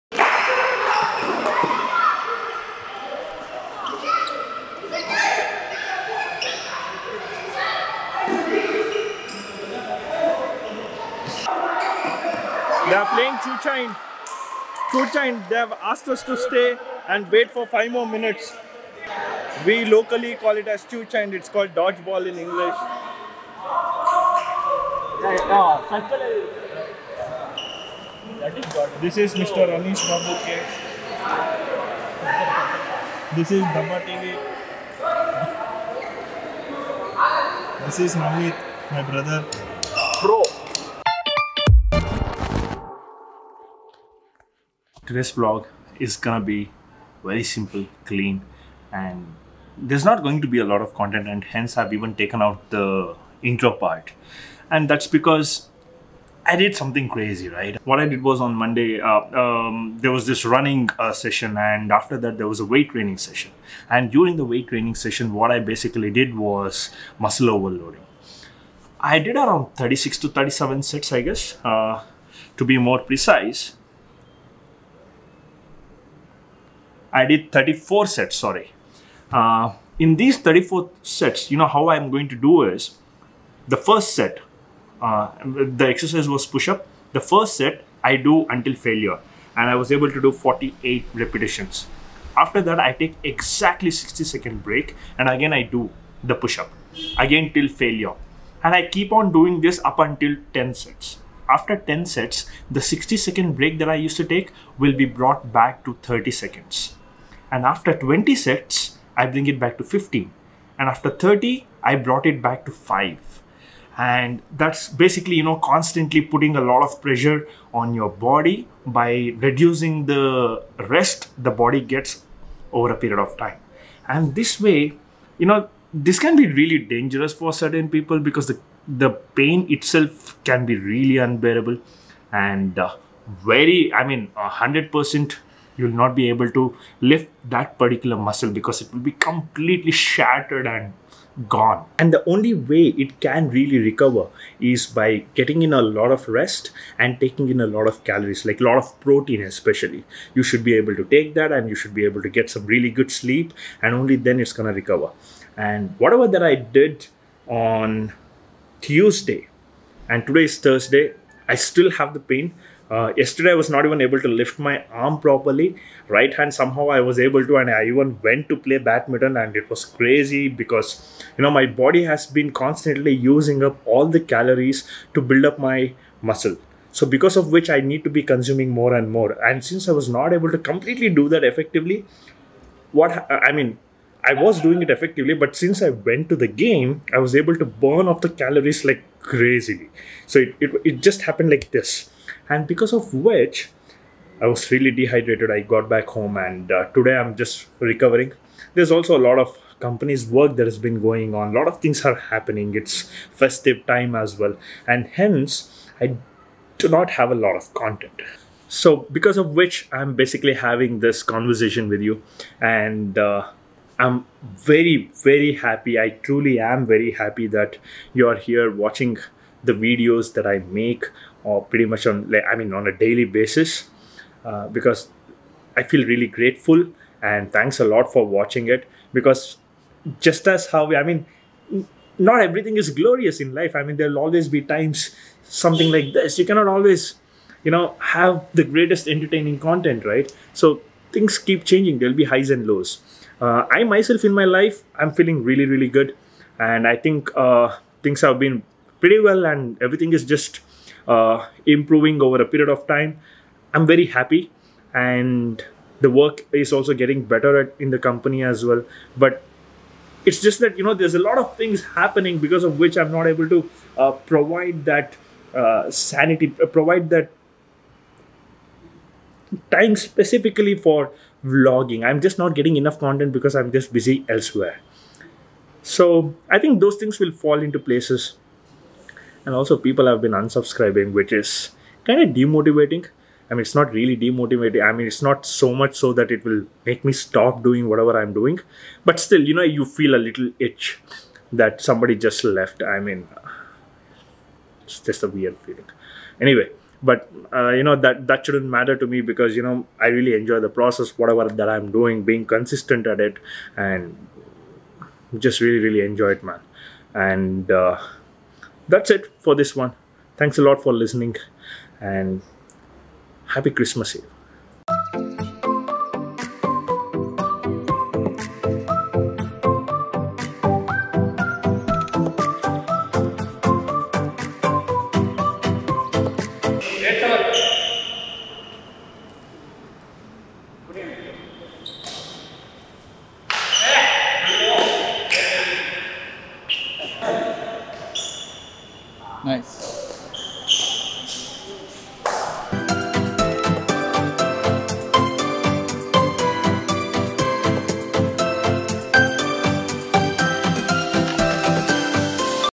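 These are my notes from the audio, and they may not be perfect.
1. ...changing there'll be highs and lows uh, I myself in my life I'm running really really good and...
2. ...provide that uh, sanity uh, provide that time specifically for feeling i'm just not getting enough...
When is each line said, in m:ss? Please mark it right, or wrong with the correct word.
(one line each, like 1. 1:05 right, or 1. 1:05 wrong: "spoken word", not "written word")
1. 4:01 wrong: "feeling", not "running"
2. 4:24 wrong: "vlogging", not "feeling".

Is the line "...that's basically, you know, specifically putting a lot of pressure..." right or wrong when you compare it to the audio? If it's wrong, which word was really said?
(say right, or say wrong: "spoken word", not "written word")
wrong: "constantly", not "specifically".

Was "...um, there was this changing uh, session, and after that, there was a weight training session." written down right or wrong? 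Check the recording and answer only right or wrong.
wrong.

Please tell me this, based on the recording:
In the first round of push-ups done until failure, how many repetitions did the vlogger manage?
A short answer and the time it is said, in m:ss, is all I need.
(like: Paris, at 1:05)
48, at 1:30.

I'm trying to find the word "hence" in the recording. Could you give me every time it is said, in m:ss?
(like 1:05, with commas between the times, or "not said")
0:51, 3:25.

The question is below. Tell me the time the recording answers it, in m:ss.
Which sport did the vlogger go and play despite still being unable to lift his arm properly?
2:48.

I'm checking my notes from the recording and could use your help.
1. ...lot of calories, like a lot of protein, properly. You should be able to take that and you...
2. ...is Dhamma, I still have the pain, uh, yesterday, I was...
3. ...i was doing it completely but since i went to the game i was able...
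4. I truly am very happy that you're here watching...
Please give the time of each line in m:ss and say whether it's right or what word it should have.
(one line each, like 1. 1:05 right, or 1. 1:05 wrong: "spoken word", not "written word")
1. 2:27 wrong: "especially", not "properly"
2. 2:40 wrong: "Thursday", not "Dhamma"
3. 3:04 wrong: "effectively", not "completely"
4. 3:35 right.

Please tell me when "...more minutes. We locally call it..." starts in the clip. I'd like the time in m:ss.
0:17.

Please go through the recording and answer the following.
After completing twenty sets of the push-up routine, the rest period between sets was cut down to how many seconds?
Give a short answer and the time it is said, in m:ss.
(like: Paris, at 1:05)
15, at 1:49.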